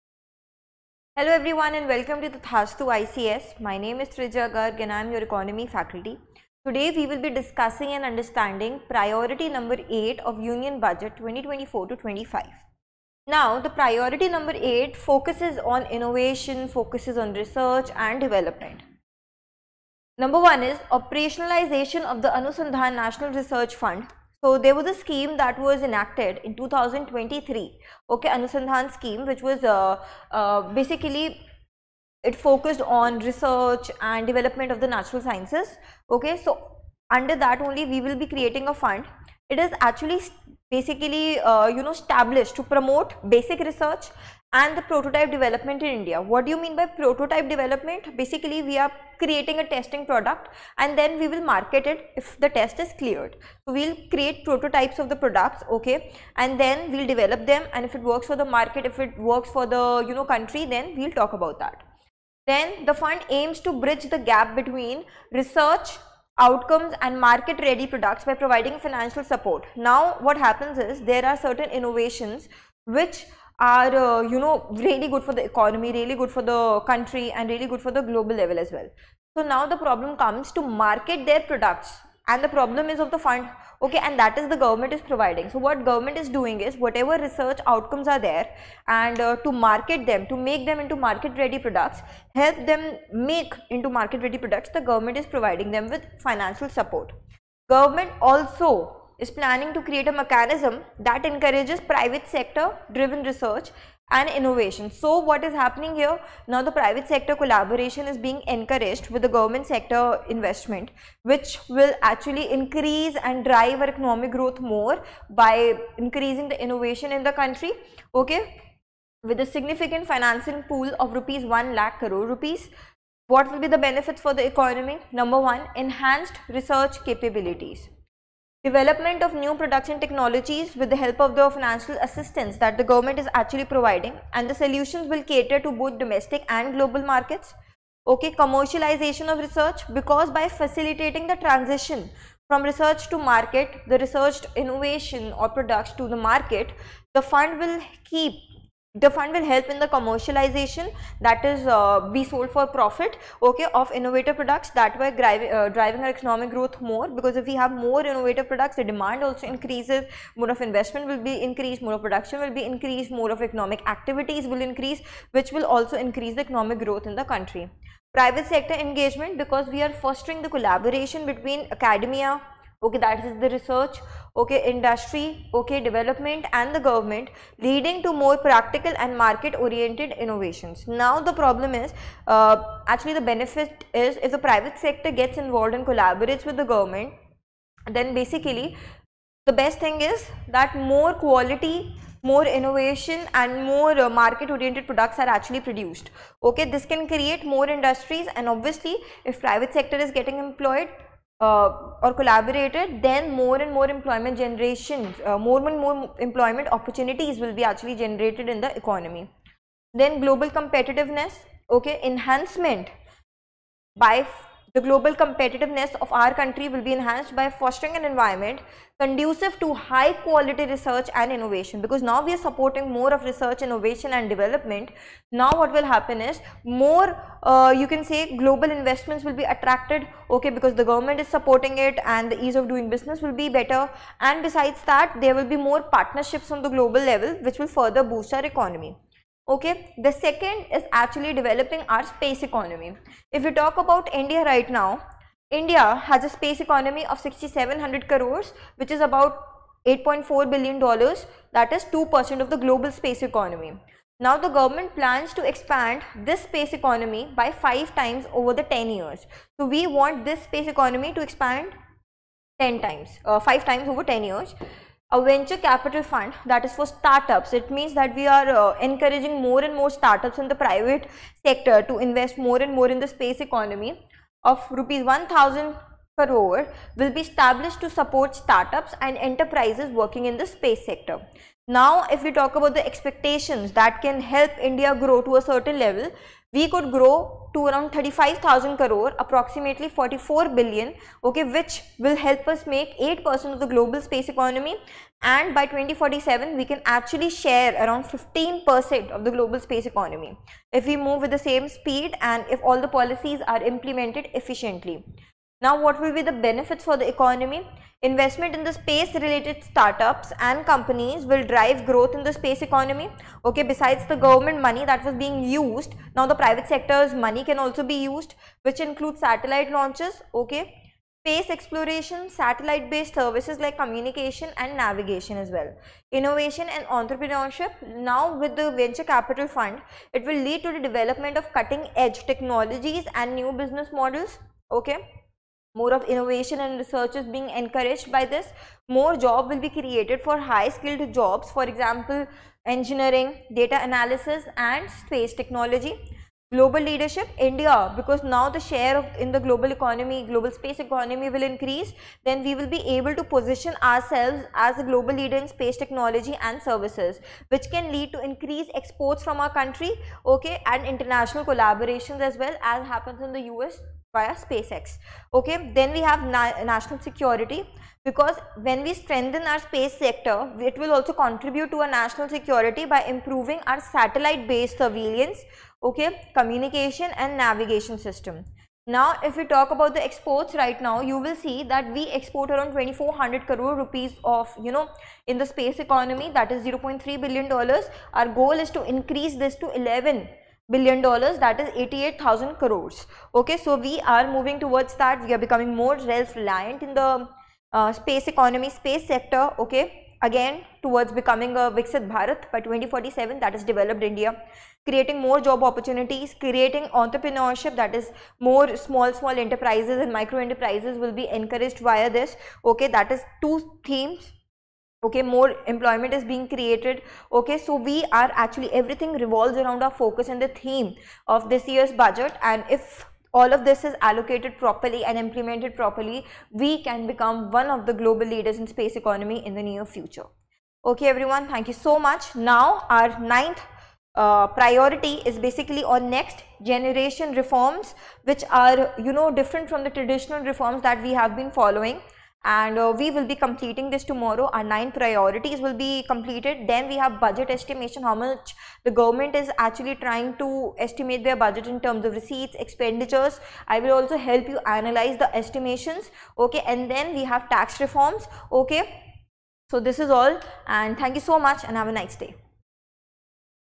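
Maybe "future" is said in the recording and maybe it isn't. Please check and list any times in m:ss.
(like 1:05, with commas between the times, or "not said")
7:09.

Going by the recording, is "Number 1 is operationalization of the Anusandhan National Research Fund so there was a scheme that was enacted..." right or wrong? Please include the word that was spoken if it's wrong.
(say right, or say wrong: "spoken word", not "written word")
right.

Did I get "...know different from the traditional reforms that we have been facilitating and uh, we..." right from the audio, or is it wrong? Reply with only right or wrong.
wrong.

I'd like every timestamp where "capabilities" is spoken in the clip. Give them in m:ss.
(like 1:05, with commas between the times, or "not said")
2:07.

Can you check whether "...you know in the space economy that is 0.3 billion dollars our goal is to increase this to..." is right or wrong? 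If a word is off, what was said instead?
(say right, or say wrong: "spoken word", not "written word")
right.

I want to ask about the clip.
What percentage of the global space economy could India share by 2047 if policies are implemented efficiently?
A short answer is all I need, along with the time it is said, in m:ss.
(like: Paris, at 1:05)
15%, at 4:58.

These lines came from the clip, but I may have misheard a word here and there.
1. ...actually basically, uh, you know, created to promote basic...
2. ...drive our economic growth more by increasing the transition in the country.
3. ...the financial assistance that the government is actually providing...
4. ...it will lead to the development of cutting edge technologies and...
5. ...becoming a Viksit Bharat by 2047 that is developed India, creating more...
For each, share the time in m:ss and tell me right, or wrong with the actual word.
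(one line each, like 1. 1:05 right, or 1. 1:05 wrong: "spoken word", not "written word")
1. 0:39 wrong: "established", not "created"
2. 1:53 wrong: "innovation", not "transition"
3. 2:11 right
4. 5:30 right
5. 6:41 right.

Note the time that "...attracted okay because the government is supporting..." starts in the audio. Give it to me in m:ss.
3:49.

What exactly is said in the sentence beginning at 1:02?
Then the fund aims to bridge the gap between research, outcomes and market ready products by providing financial support.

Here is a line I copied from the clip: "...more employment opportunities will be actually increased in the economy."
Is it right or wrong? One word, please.
wrong.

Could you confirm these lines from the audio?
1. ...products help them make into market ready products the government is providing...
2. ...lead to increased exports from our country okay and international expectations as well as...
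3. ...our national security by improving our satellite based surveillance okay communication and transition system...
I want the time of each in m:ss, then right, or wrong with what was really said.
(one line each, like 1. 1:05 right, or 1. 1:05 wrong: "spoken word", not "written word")
1. 1:31 right
2. 5:57 wrong: "collaborations", not "expectations"
3. 6:11 wrong: "navigation", not "transition".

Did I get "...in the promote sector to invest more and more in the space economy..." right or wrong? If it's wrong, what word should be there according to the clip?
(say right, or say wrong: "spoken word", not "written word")
wrong: "private", not "promote".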